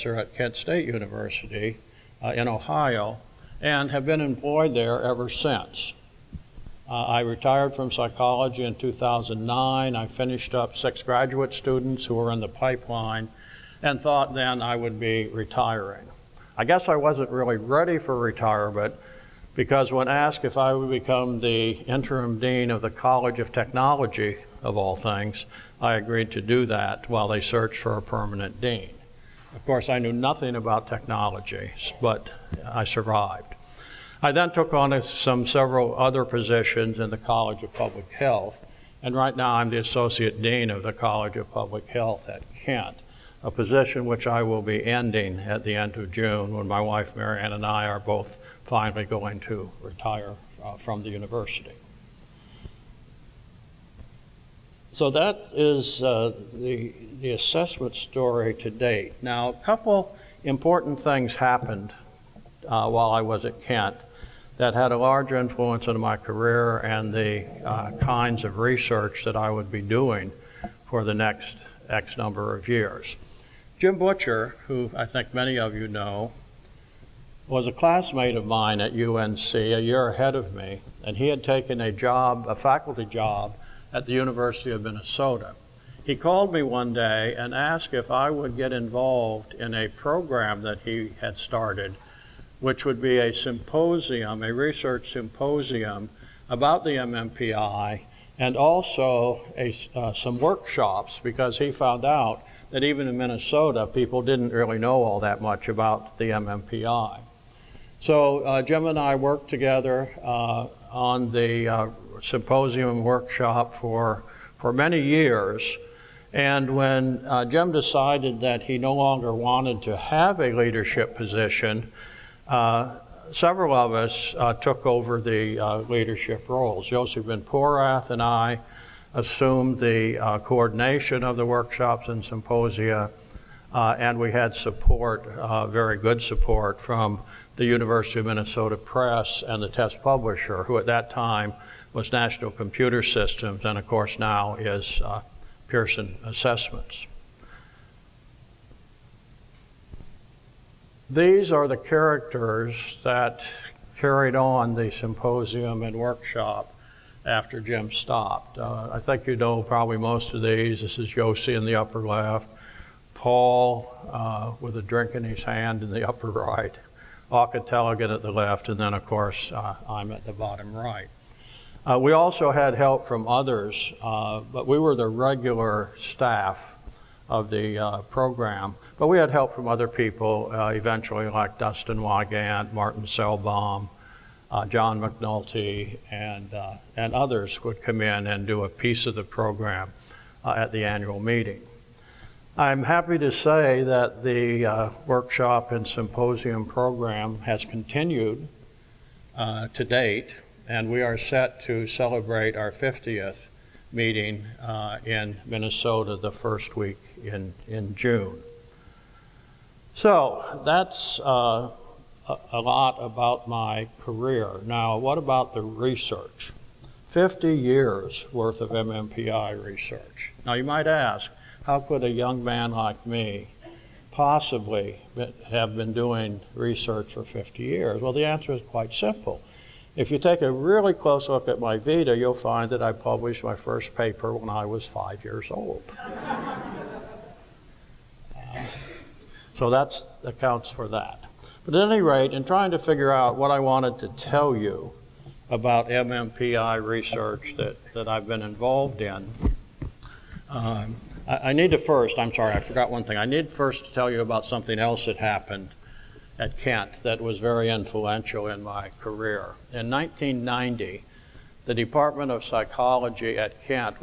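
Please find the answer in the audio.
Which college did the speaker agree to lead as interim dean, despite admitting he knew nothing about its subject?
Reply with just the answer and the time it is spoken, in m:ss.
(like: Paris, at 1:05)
College of Technology, at 0:22.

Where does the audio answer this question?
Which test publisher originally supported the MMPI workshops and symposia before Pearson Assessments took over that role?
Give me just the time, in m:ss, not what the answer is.
2:22.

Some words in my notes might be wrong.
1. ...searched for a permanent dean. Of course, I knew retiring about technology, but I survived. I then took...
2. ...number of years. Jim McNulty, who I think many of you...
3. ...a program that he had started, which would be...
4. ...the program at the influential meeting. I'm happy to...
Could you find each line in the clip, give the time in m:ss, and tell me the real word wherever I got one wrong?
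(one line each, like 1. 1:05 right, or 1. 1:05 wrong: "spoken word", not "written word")
1. 0:27 wrong: "nothing", not "retiring"
2. 1:12 wrong: "Butcher", not "McNulty"
3. 1:29 right
4. 3:09 wrong: "annual", not "influential".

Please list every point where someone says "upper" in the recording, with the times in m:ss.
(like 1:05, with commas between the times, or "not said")
2:41, 2:46.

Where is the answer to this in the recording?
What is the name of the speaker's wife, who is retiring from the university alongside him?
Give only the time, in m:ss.
0:47.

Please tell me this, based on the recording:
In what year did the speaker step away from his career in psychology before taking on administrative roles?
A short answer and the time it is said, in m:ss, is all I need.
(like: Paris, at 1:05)
2009, at 0:08.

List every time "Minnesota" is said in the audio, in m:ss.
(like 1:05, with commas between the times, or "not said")
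1:24, 1:43, 2:18, 3:25.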